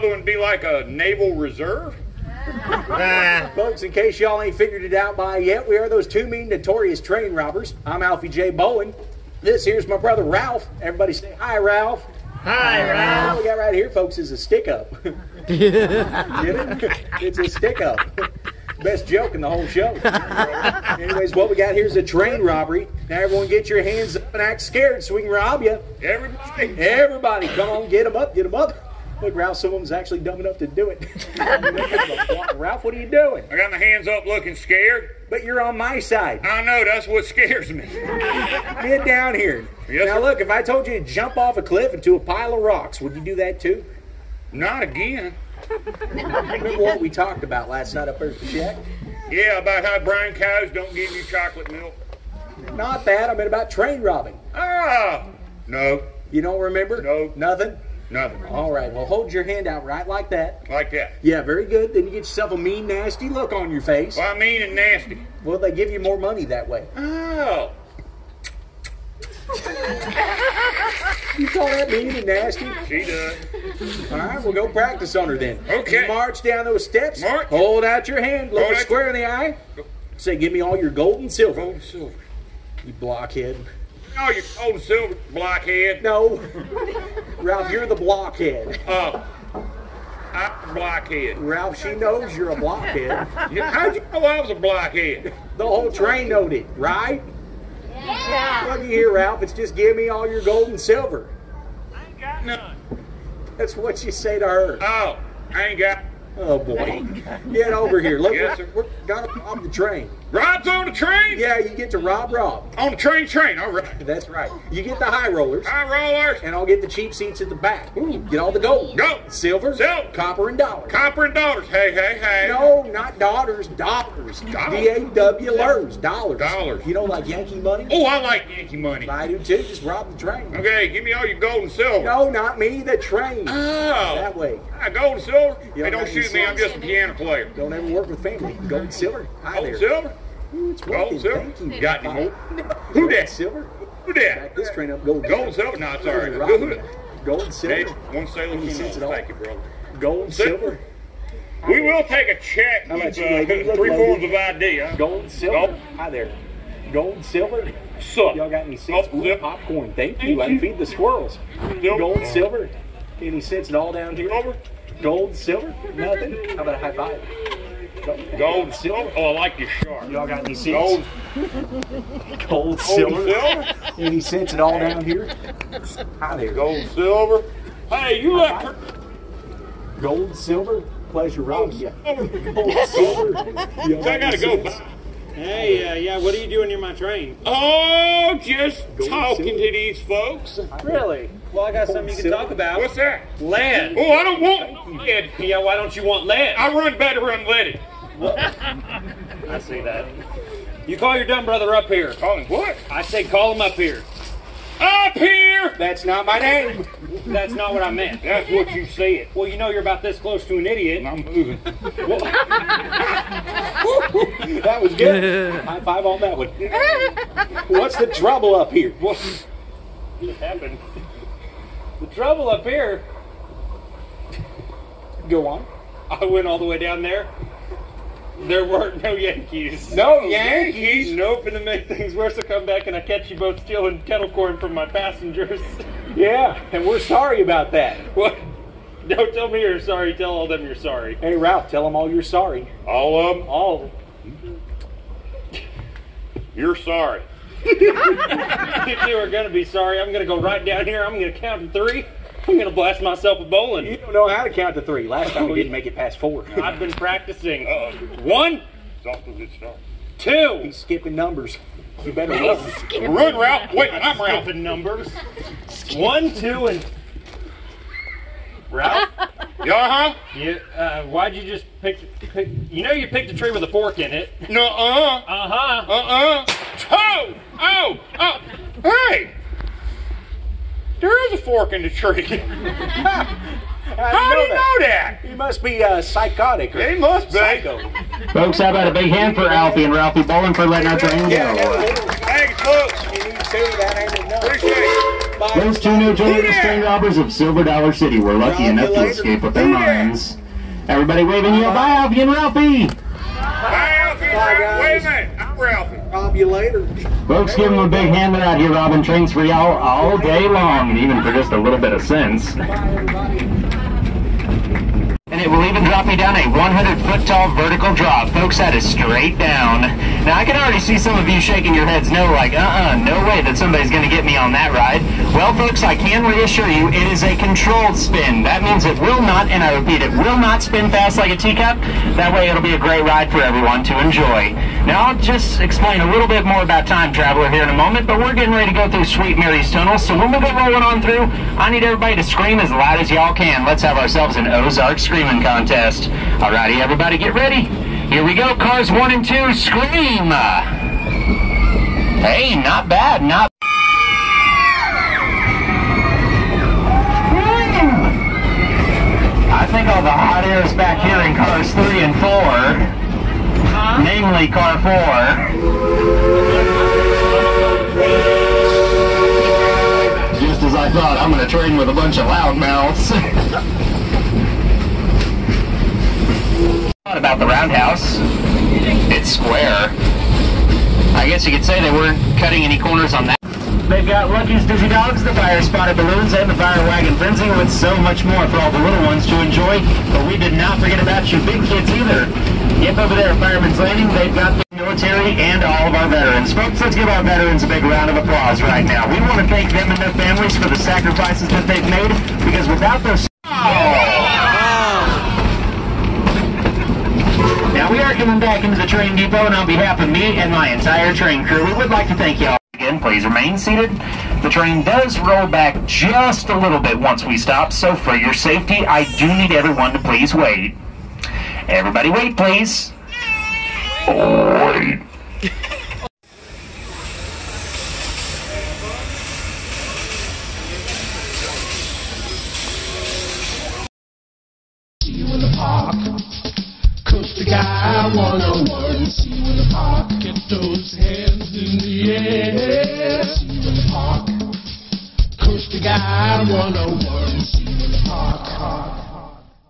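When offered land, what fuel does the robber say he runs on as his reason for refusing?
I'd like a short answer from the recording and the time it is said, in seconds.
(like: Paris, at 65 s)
Unleaded, at 197 s.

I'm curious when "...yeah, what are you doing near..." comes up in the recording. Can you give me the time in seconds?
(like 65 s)
185 s.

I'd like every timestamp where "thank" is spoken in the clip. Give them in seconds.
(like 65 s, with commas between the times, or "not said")
148 s, 159 s, 292 s, 399 s, 412 s.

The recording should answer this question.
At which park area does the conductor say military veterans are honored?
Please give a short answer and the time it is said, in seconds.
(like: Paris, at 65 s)
Fireman's Landing, at 393 s.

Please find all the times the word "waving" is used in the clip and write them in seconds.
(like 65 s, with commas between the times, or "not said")
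301 s.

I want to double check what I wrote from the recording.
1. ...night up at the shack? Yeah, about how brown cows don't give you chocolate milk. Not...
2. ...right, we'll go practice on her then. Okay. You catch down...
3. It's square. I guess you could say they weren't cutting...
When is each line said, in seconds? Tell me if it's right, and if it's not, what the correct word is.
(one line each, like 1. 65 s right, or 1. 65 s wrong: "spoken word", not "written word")
1. 47 s right
2. 74 s wrong: "march", not "catch"
3. 379 s right.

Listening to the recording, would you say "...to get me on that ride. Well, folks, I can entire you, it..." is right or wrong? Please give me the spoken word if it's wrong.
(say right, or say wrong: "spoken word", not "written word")
wrong: "reassure", not "entire".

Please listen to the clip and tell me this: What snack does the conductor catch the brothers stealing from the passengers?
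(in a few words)
Kettle corn.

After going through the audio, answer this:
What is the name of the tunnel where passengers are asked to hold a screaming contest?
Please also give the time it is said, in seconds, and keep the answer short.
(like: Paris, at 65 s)
Sweet Mary's Tunnel, at 339 s.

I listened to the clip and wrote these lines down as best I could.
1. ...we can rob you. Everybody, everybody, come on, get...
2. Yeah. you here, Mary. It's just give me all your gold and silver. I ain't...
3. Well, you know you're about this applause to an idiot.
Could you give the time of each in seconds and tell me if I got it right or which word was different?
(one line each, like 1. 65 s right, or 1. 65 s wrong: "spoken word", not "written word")
1. 25 s right
2. 97 s wrong: "Ralph", not "Mary"
3. 209 s wrong: "close", not "applause".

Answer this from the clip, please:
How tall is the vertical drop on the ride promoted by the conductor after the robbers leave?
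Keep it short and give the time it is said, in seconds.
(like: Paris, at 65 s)
100 feet, at 316 s.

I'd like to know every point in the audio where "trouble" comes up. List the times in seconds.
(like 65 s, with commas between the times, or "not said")
218 s, 222 s.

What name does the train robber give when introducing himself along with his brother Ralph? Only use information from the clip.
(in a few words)
Alfie J. Bowen.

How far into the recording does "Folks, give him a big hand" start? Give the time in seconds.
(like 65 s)
307 s.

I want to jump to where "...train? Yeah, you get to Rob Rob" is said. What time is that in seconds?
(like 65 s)
110 s.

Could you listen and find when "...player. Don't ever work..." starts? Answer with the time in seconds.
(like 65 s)
137 s.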